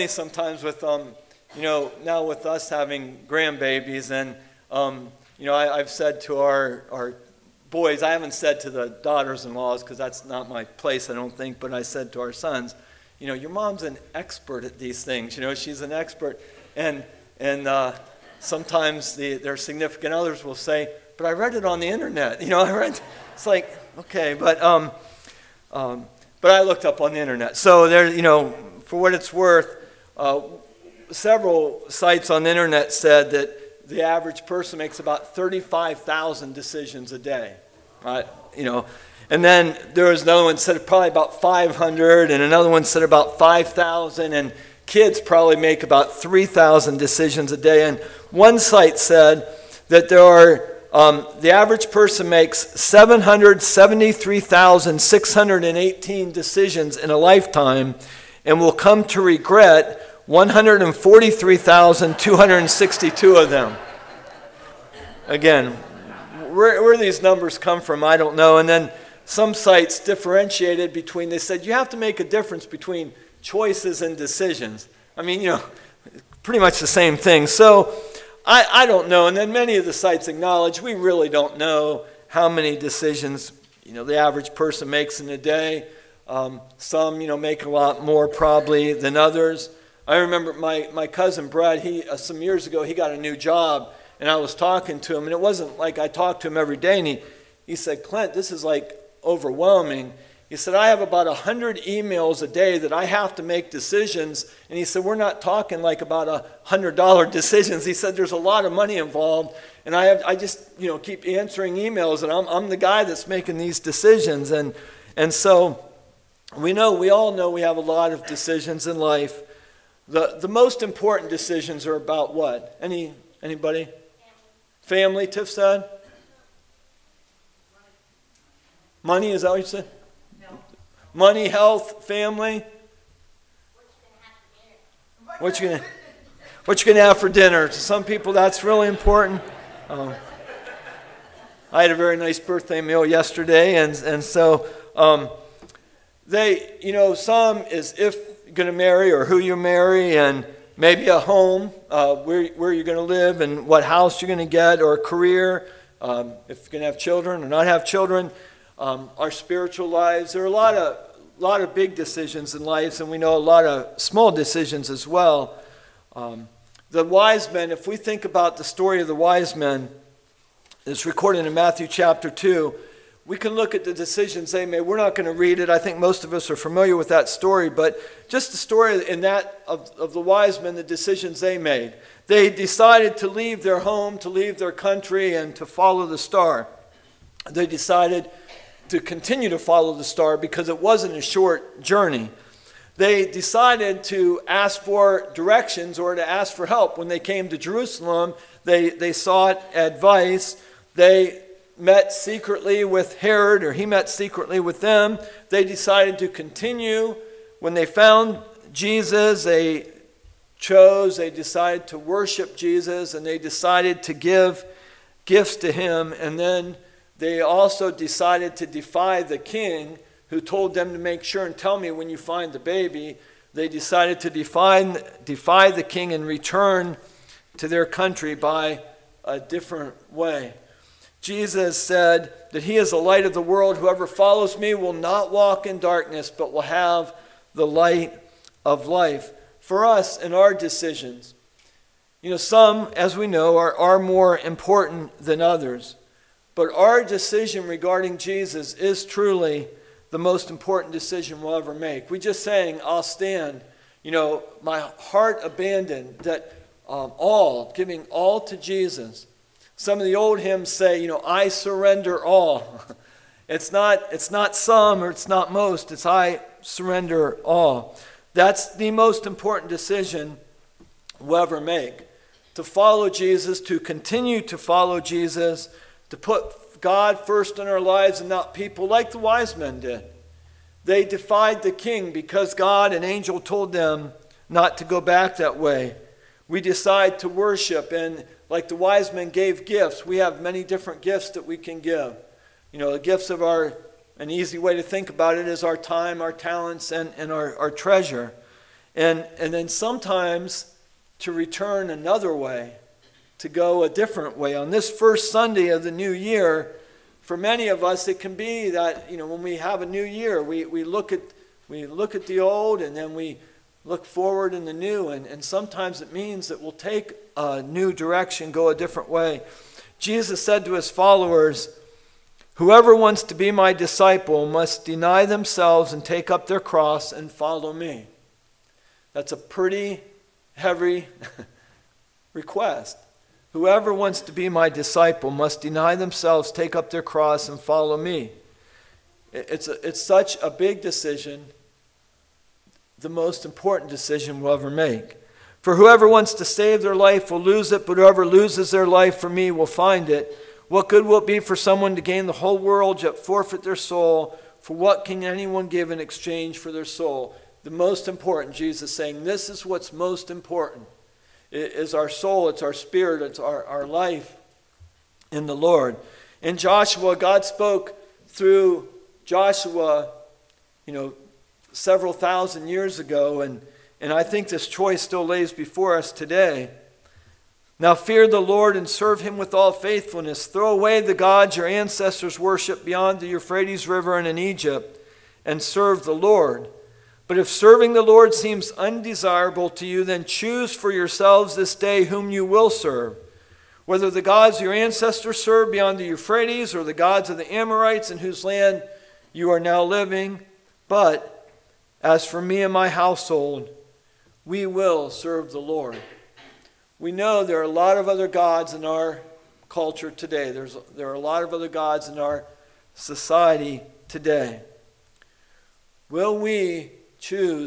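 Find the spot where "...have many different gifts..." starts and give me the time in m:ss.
4:50.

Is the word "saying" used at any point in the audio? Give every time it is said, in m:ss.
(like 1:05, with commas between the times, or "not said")
4:12, 5:58.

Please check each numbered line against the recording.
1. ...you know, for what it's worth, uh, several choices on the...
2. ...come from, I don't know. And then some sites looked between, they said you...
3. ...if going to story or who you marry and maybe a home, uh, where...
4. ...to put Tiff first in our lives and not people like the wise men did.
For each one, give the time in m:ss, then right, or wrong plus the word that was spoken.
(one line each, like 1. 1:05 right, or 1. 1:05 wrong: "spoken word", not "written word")
1. 0:28 wrong: "sites", not "choices"
2. 1:07 wrong: "differentiated", not "looked"
3. 2:27 wrong: "marry", not "story"
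4. 4:36 wrong: "God", not "Tiff".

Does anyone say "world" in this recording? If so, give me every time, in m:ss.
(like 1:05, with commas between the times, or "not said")
3:53, 5:52.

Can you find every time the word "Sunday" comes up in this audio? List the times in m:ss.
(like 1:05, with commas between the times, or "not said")
5:05.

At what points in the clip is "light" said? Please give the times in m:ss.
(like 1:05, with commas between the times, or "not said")
3:52, 3:57.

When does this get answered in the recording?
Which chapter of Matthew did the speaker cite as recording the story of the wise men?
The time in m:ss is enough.
2:51.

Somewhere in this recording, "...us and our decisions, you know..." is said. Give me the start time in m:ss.
3:59.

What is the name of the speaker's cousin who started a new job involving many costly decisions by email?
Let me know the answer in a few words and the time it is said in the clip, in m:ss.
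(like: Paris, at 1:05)
Brad, at 1:31.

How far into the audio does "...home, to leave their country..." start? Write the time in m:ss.
3:03.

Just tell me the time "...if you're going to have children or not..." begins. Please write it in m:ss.
2:36.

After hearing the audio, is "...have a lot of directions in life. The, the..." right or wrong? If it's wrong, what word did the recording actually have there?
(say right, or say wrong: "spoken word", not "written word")
wrong: "decisions", not "directions".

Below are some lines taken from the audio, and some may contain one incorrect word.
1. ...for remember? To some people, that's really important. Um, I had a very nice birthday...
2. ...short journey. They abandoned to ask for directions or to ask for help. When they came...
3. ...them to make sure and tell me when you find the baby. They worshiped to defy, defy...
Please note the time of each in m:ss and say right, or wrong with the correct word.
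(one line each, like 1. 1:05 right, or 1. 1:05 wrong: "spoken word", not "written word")
1. 2:17 wrong: "dinner", not "remember"
2. 3:11 wrong: "decided", not "abandoned"
3. 3:40 wrong: "decided", not "worshiped".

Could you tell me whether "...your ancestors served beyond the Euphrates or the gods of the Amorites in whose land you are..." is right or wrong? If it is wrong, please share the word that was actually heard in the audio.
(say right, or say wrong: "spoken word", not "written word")
right.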